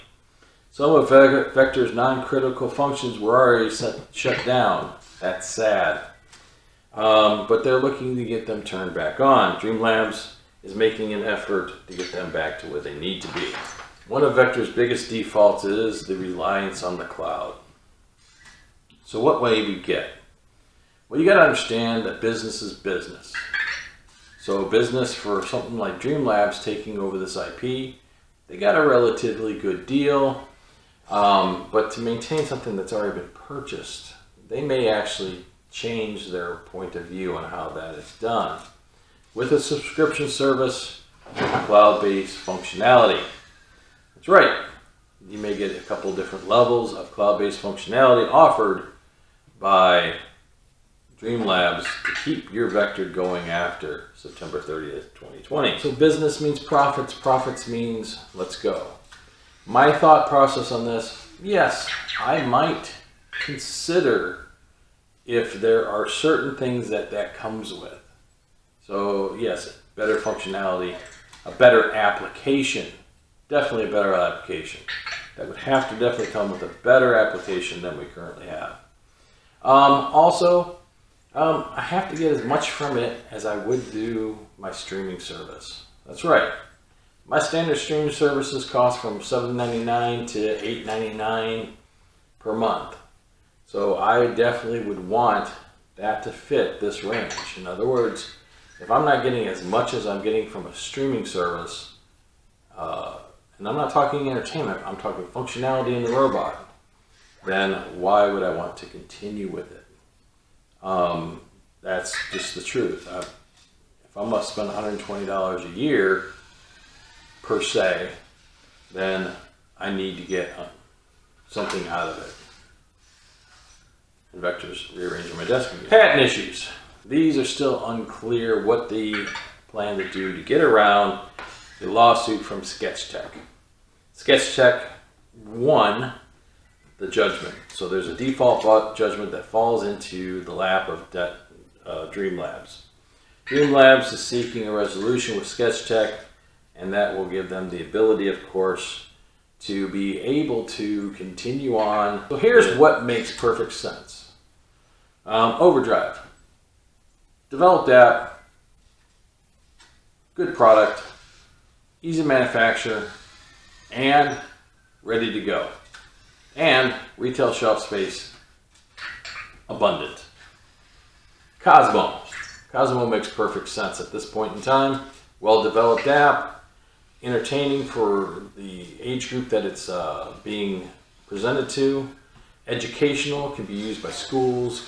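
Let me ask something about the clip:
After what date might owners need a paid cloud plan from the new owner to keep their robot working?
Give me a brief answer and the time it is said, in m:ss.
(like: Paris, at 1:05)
September 30th, 2020, at 0:54.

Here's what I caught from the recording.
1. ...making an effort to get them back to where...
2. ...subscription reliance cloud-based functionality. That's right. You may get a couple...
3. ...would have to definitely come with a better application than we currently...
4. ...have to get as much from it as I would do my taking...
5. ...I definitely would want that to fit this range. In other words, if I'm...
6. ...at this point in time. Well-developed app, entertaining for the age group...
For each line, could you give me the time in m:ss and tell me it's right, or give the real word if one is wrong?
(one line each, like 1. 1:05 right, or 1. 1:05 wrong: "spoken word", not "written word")
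1. 0:10 right
2. 0:39 wrong: "service", not "reliance"
3. 1:15 right
4. 1:21 wrong: "streaming", not "taking"
5. 1:33 right
6. 2:54 right.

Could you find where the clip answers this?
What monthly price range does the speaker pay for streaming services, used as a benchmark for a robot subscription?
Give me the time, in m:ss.
1:29.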